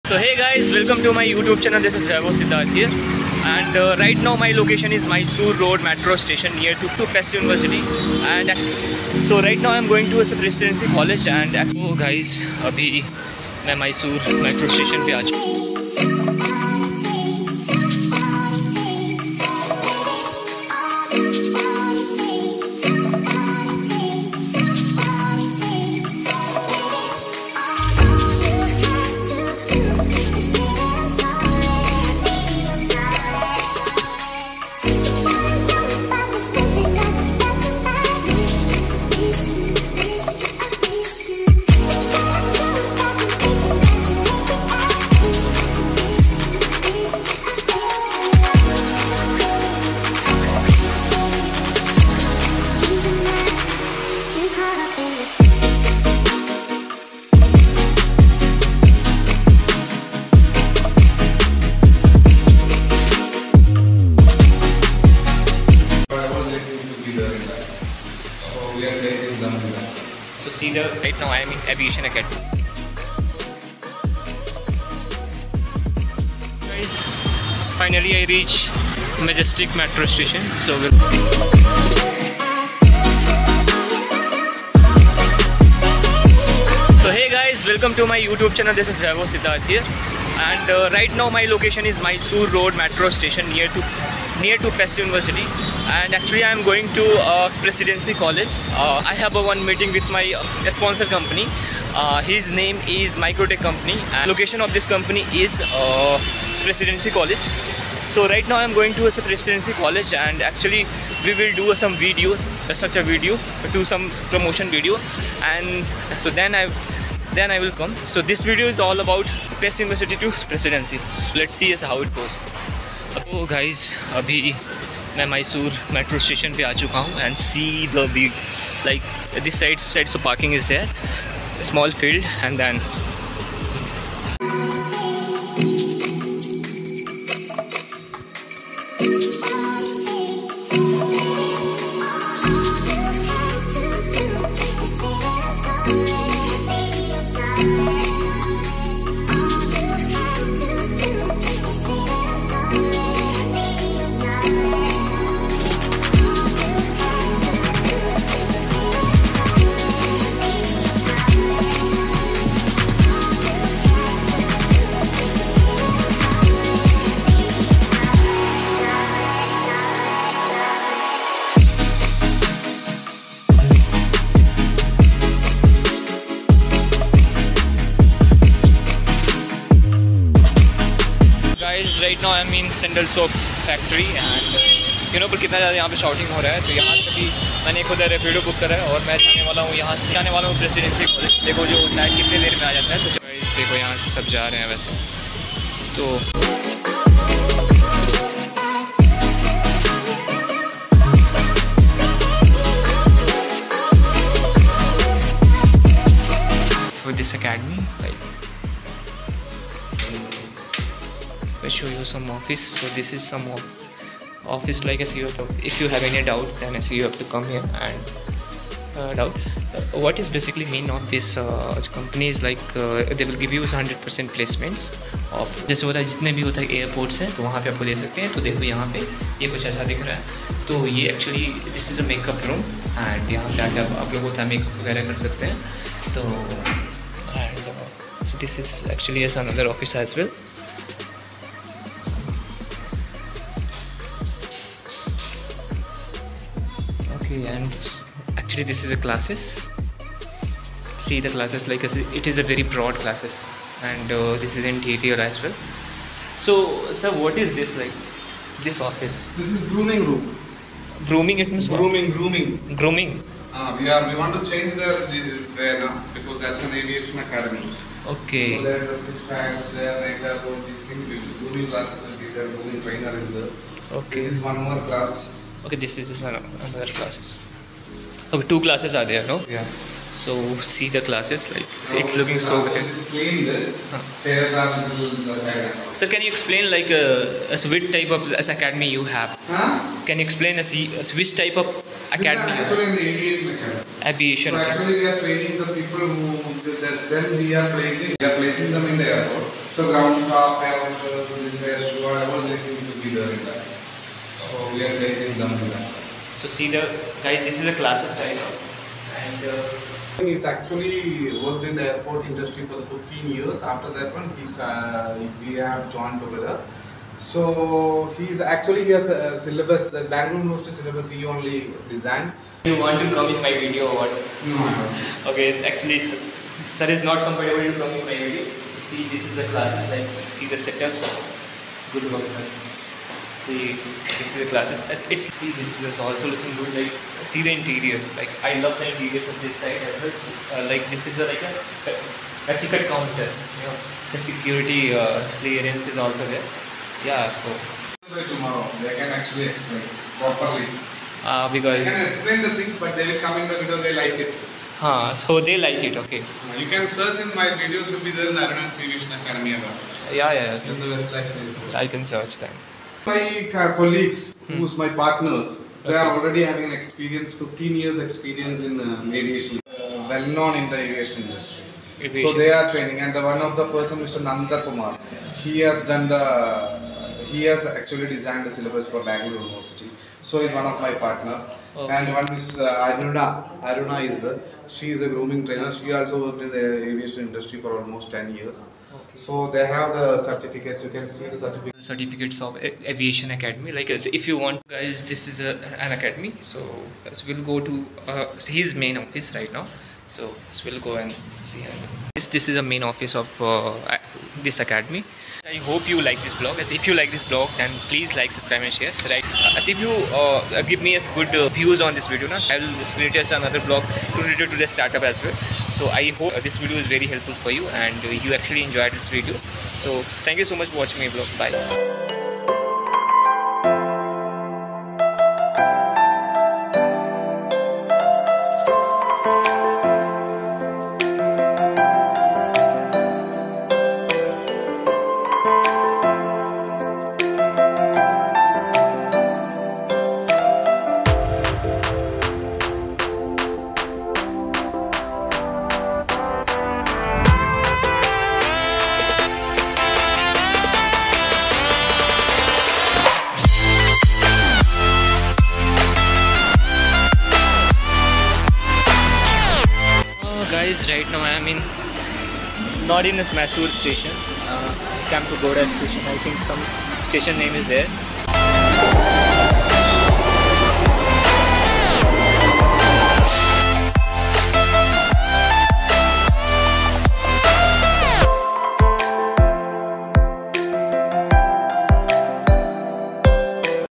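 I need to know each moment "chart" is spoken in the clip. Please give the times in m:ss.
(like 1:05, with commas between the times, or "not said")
not said.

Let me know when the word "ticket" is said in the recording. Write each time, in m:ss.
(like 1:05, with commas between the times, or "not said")
5:42.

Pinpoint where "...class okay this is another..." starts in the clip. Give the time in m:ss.
4:34.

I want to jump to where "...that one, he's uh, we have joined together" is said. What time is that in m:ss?
5:13.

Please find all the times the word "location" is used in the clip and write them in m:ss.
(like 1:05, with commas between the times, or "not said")
0:04, 1:31, 1:44.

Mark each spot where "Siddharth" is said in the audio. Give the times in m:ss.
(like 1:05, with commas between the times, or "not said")
0:02, 1:29.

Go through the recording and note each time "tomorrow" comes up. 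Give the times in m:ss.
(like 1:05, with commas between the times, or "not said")
5:48.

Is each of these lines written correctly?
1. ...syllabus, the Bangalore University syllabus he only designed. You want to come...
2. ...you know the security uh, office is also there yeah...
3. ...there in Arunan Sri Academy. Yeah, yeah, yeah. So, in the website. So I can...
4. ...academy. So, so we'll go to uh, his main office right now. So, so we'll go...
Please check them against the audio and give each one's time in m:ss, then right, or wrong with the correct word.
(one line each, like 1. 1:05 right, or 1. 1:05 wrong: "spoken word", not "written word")
1. 5:19 right
2. 5:43 wrong: "clearance", not "office"
3. 5:58 right
4. 6:35 right.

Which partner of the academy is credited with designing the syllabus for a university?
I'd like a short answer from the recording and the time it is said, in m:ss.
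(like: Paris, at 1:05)
Nanda Kumar, at 6:13.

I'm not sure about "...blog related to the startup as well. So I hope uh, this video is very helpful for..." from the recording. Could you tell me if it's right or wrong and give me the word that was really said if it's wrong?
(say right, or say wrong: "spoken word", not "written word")
right.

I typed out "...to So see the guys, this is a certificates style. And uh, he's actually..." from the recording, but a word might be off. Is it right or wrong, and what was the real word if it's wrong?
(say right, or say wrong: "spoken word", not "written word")
wrong: "classes", not "certificates".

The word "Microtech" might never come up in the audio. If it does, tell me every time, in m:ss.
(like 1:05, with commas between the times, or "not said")
1:43.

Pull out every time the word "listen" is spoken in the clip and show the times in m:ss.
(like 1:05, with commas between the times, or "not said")
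not said.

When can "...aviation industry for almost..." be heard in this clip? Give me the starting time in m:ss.
6:26.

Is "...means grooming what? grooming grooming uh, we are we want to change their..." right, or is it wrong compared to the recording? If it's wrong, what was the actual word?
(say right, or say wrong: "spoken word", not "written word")
right.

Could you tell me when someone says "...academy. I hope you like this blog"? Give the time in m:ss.
6:44.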